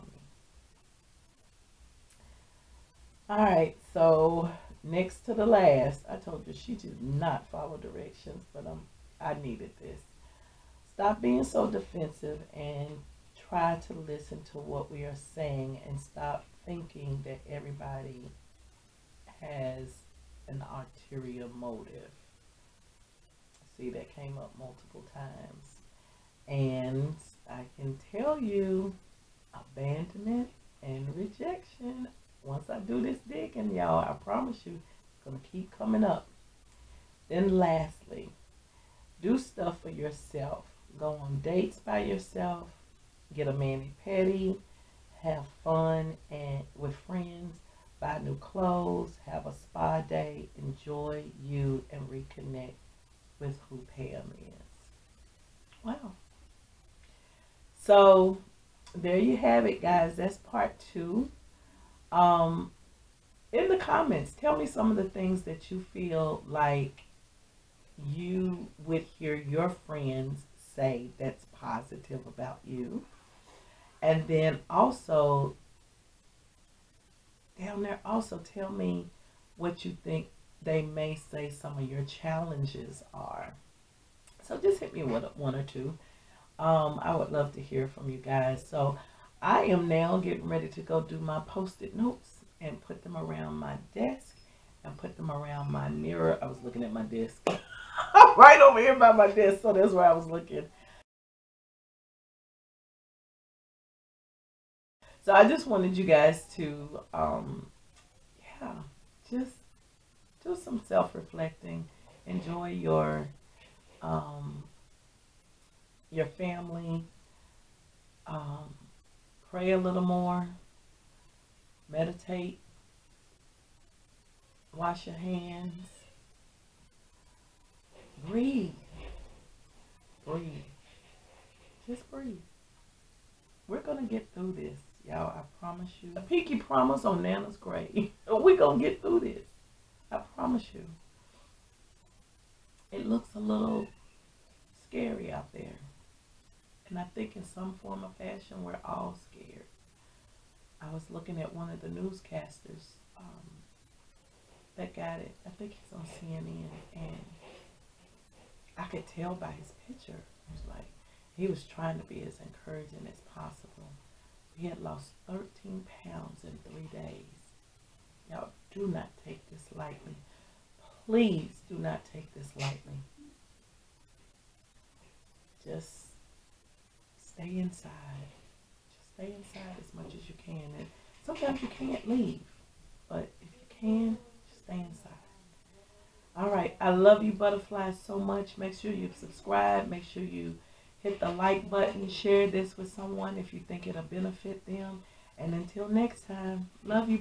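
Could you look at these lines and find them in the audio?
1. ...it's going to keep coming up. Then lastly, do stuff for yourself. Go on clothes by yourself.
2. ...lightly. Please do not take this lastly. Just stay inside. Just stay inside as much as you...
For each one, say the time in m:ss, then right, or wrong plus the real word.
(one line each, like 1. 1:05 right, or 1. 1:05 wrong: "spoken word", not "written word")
1. 0:35 wrong: "dates", not "clothes"
2. 2:49 wrong: "lightly", not "lastly".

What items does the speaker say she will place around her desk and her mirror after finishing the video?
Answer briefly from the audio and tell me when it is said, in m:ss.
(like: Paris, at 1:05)
Post-it notes, at 1:31.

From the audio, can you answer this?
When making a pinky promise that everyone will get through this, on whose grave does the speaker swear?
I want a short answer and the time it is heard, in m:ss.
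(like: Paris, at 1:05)
Nana's, at 2:17.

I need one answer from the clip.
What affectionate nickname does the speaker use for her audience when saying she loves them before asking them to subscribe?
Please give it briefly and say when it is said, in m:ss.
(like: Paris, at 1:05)
Butterflies, at 3:07.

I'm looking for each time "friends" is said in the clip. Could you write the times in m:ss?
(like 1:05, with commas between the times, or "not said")
0:46, 1:09.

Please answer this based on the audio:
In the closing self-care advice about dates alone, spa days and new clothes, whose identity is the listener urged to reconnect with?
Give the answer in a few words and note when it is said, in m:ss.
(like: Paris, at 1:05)
Pam, at 0:53.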